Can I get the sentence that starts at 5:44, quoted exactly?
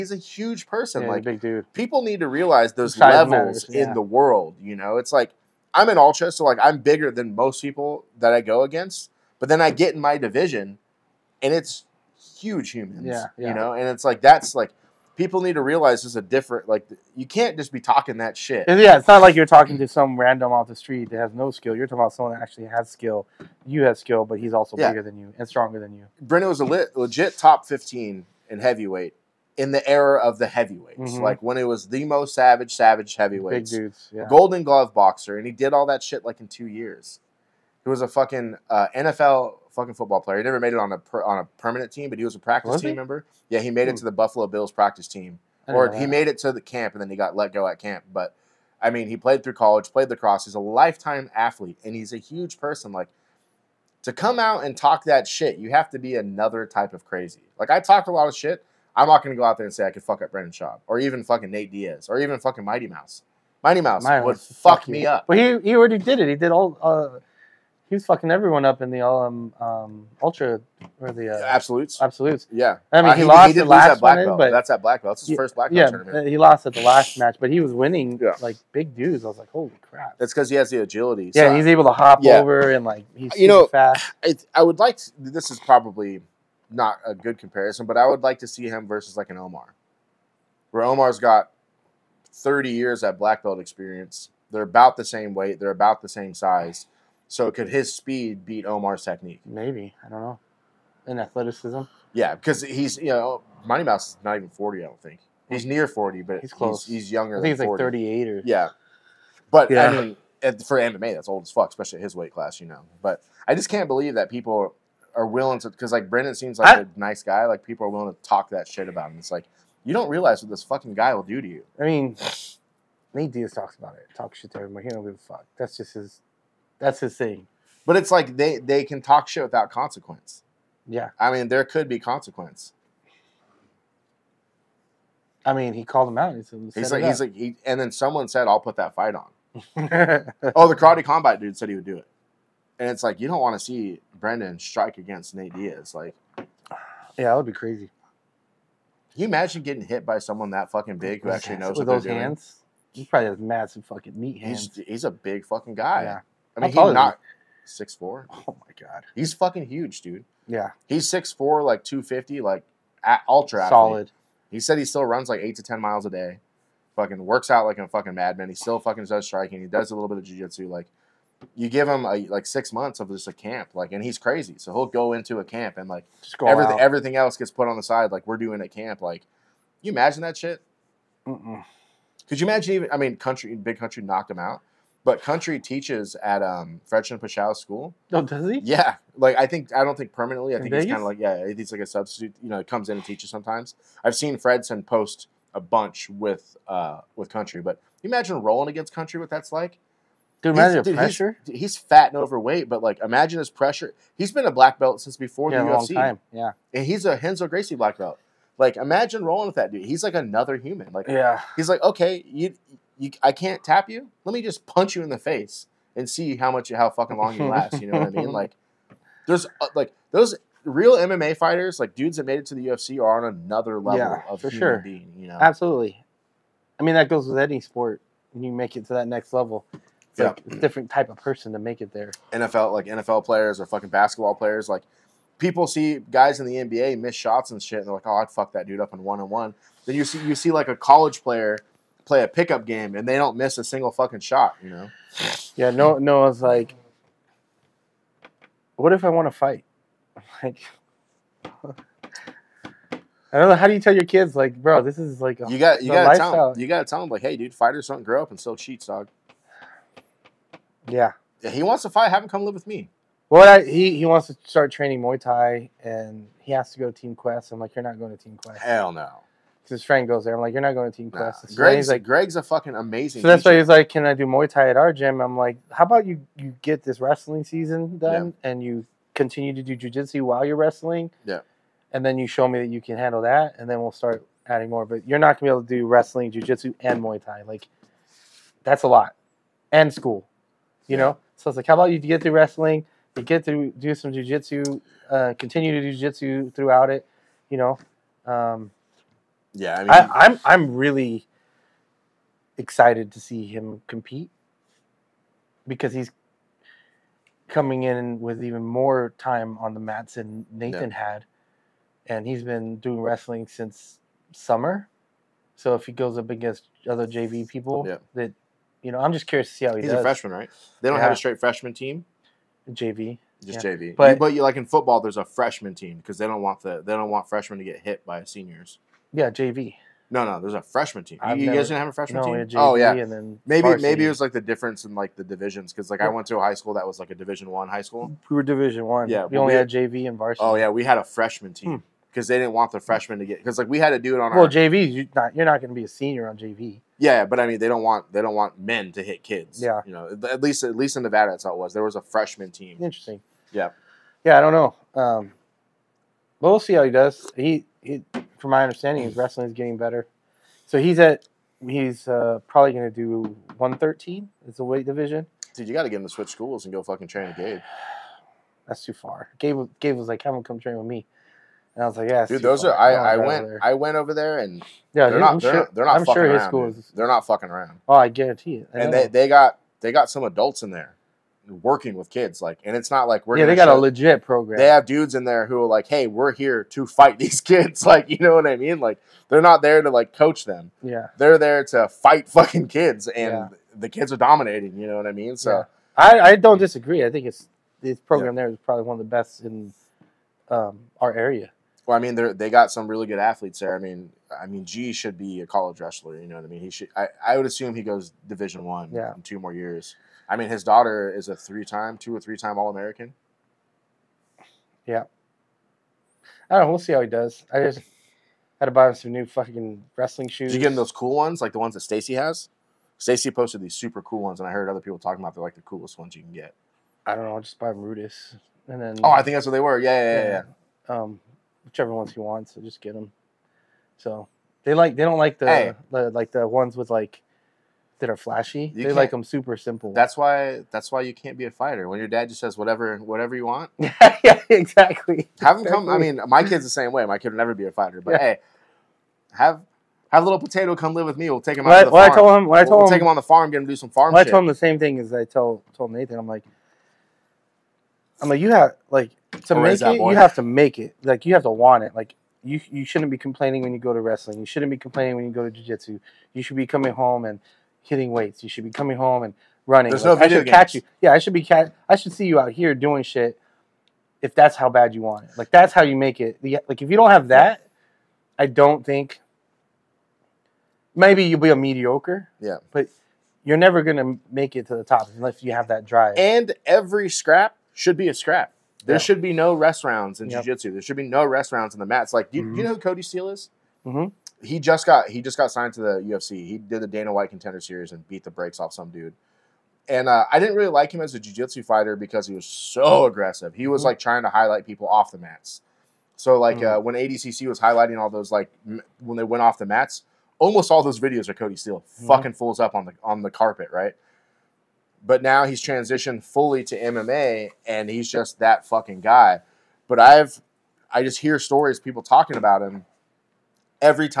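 You're not you're not going to be a senior on JV.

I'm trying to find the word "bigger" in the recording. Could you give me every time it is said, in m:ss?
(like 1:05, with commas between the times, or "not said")
0:06, 0:24.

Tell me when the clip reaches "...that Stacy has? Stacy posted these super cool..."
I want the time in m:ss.
7:01.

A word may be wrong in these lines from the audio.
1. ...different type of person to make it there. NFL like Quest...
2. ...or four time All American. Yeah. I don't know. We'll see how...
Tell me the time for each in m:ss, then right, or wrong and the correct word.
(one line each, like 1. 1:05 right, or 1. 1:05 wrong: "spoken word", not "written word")
1. 3:50 wrong: "NFL", not "Quest"
2. 6:52 wrong: "three", not "four".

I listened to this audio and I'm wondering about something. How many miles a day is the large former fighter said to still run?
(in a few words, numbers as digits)
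8 to 10.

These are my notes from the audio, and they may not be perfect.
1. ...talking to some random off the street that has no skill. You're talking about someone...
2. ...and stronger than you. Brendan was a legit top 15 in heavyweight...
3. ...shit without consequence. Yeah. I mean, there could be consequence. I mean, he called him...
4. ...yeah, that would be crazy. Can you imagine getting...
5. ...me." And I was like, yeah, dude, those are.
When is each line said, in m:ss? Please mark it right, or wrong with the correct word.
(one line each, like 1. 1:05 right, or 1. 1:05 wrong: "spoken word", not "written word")
1. 0:19 right
2. 0:25 right
3. 2:09 right
4. 2:26 right
5. 6:10 right.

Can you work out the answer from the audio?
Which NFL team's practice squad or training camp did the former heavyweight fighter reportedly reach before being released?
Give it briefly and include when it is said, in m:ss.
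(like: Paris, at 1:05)
Buffalo Bills, at 0:44.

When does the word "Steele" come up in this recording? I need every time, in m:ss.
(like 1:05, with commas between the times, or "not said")
8:13, 8:31.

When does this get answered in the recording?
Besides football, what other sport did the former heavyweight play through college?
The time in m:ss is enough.
0:50.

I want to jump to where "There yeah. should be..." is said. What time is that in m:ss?
8:08.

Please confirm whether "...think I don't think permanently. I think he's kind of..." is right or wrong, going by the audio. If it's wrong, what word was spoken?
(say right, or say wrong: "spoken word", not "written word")
right.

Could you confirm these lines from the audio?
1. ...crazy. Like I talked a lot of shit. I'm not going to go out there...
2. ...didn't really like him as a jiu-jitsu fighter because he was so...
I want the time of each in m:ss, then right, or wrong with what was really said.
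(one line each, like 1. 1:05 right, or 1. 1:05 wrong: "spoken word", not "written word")
1. 0:57 right
2. 8:20 right.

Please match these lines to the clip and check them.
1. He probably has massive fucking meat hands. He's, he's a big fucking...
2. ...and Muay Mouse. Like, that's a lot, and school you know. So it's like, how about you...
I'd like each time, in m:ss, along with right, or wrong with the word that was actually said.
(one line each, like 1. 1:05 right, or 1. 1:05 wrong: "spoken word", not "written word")
1. 2:33 right
2. 4:46 wrong: "Thai", not "Mouse".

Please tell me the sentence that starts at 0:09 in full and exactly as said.
But then I get in my division, and it's huge humans.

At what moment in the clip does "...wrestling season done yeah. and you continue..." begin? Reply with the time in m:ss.
4:36.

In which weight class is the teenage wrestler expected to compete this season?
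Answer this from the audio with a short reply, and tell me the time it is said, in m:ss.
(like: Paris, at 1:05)
113, at 6:03.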